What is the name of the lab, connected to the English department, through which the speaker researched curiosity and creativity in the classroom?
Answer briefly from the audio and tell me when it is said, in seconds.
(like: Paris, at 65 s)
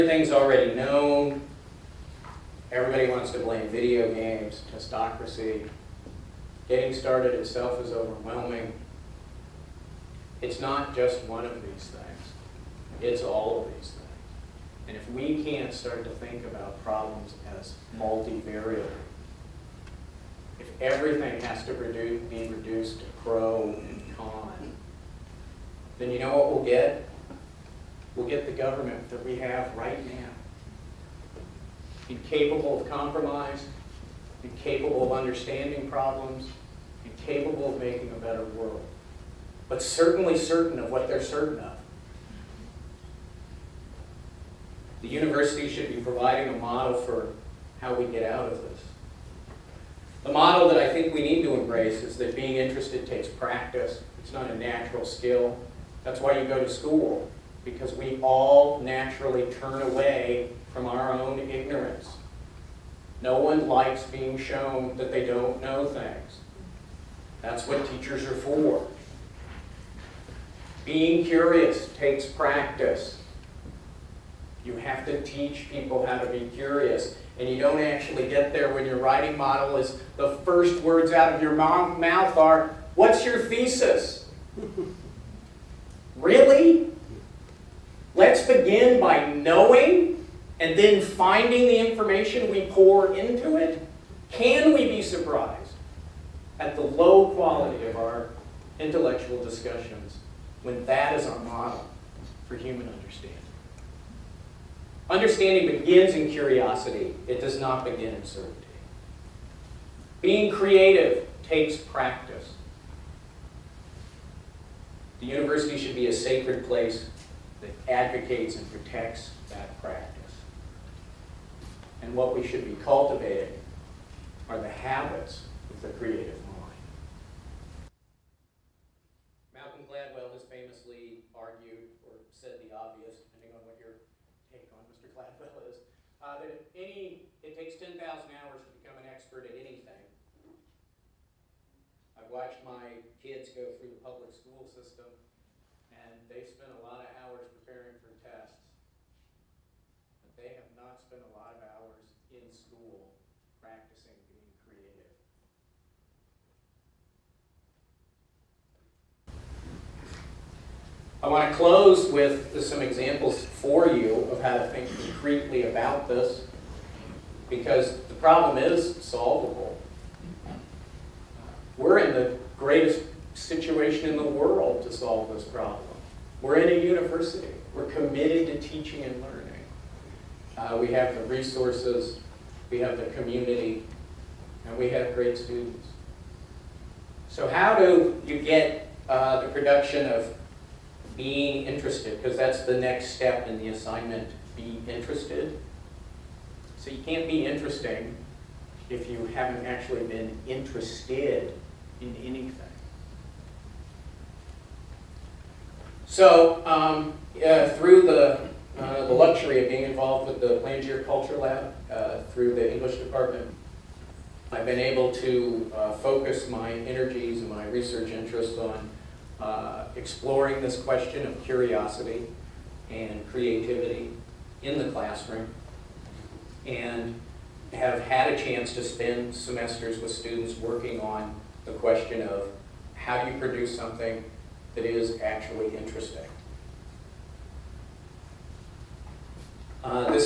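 Plangere Culture Lab, at 210 s.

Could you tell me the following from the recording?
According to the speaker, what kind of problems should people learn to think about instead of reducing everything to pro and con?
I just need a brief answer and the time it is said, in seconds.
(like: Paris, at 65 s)
multivariable, at 17 s.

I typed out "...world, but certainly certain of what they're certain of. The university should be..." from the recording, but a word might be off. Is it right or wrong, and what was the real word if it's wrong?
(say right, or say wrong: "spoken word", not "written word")
right.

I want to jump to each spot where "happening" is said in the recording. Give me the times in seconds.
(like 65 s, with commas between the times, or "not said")
not said.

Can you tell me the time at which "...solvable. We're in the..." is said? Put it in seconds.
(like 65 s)
169 s.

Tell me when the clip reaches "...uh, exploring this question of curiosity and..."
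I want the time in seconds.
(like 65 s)
219 s.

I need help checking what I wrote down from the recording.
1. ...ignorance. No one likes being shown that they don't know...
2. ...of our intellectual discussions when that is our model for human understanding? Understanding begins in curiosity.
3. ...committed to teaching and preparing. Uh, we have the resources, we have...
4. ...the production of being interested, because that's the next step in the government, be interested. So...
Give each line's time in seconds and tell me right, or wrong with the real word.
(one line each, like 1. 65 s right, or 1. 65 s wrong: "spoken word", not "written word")
1. 61 s right
2. 97 s right
3. 177 s wrong: "learning", not "preparing"
4. 189 s wrong: "assignment", not "government".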